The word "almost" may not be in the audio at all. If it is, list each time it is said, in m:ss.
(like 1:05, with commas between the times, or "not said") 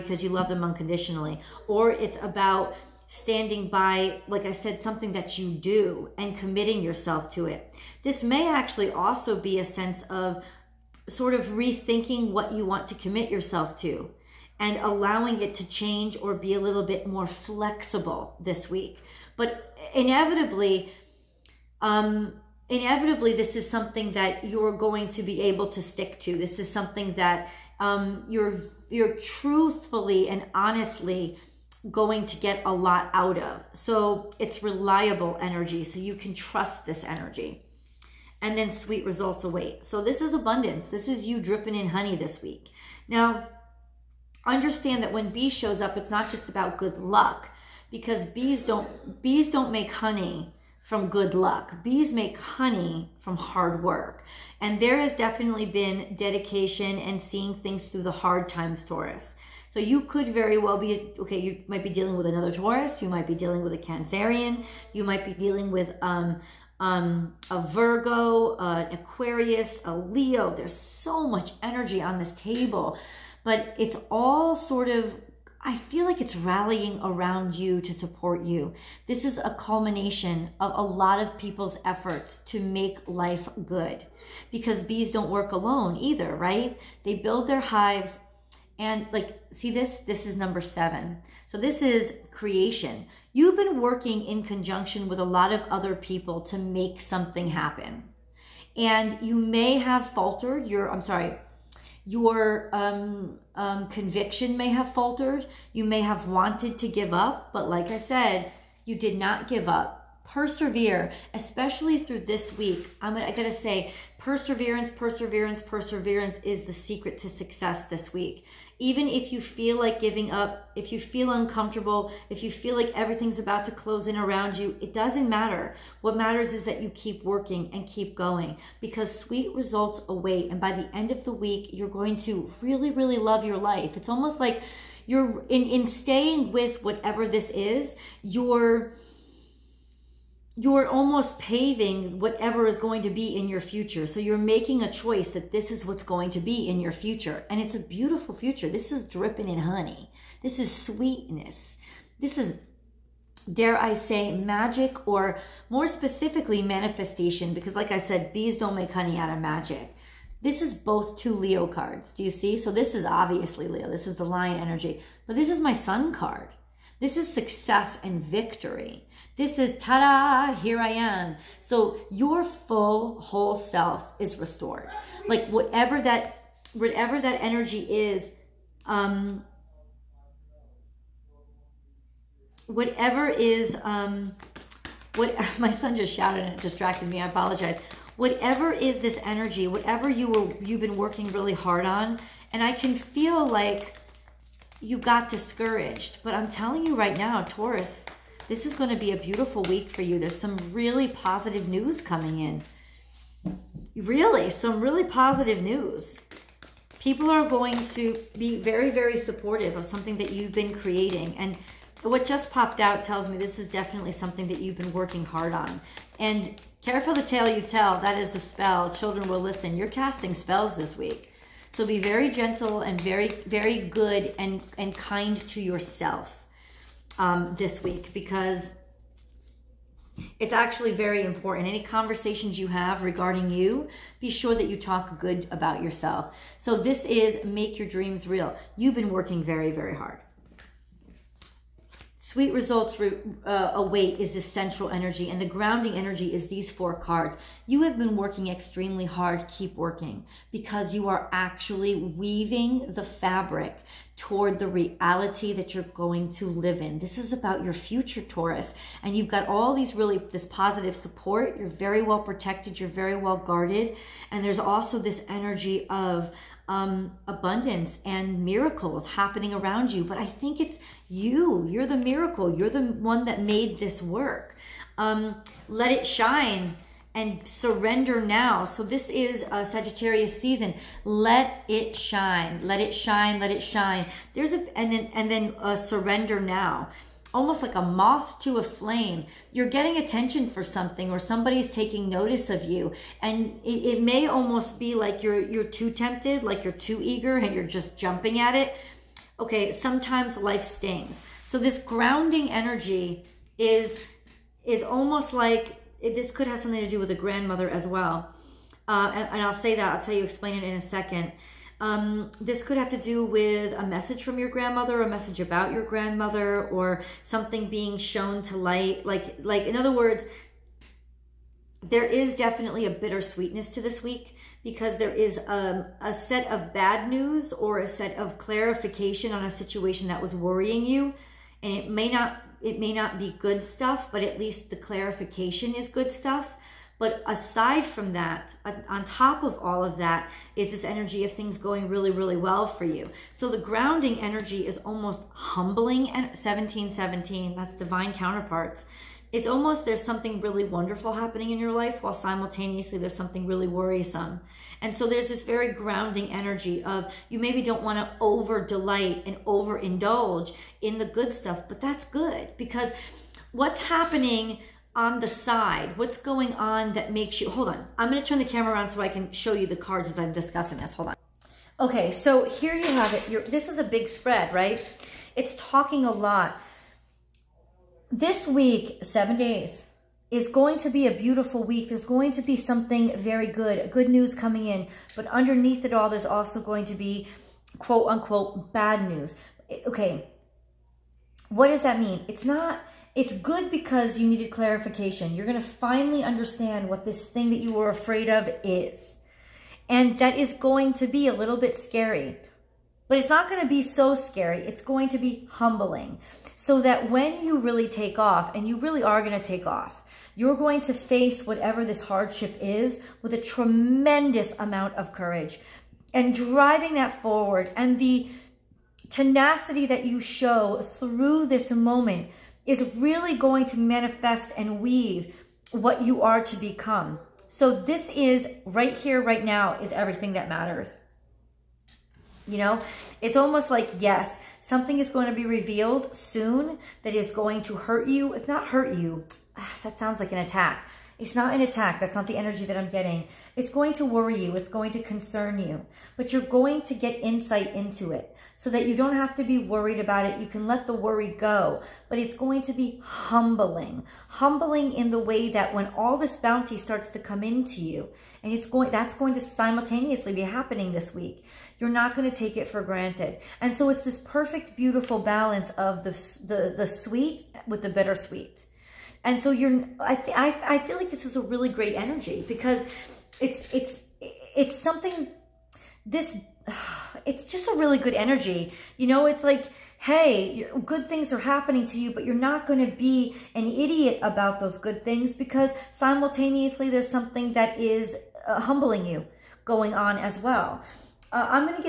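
2:14, 2:20, 4:47, 4:54, 5:04, 5:44, 5:49, 7:13.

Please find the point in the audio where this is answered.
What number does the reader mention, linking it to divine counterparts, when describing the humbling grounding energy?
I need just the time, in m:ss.
5:46.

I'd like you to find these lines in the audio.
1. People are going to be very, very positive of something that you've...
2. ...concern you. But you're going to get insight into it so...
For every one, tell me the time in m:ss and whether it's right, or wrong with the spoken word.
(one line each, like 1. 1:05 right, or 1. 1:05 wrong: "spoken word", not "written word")
1. 3:27 wrong: "supportive", not "positive"
2. 7:25 right.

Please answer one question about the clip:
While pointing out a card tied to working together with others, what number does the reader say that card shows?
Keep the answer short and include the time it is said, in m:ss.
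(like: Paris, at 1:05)
7, at 1:30.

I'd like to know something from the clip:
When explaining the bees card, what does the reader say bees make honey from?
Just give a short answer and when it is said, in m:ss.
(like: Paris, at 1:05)
Hard work, at 0:53.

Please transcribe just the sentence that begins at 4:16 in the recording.
This is about your future, Taurus.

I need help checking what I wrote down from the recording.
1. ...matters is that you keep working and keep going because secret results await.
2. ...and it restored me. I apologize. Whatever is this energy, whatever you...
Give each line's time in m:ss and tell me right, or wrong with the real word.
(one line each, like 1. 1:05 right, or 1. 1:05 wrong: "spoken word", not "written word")
1. 2:06 wrong: "sweet", not "secret"
2. 3:06 wrong: "distracted", not "restored".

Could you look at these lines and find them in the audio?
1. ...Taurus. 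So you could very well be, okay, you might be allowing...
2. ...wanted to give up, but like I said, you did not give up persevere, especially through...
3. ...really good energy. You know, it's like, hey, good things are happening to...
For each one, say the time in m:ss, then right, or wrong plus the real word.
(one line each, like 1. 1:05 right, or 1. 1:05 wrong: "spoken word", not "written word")
1. 0:58 wrong: "dealing", not "allowing"
2. 1:46 right
3. 7:57 right.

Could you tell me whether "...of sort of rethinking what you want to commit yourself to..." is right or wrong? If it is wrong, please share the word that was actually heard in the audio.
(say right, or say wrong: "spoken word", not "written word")
right.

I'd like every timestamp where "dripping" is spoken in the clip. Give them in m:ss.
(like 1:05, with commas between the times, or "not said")
0:41, 2:29.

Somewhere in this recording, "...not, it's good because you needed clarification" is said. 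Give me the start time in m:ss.
6:32.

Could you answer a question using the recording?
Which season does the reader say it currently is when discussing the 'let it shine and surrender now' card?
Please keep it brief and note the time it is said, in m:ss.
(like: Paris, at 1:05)
Sagittarius season, at 4:39.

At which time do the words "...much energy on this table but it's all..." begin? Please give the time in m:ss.
1:11.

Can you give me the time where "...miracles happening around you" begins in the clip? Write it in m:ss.
4:28.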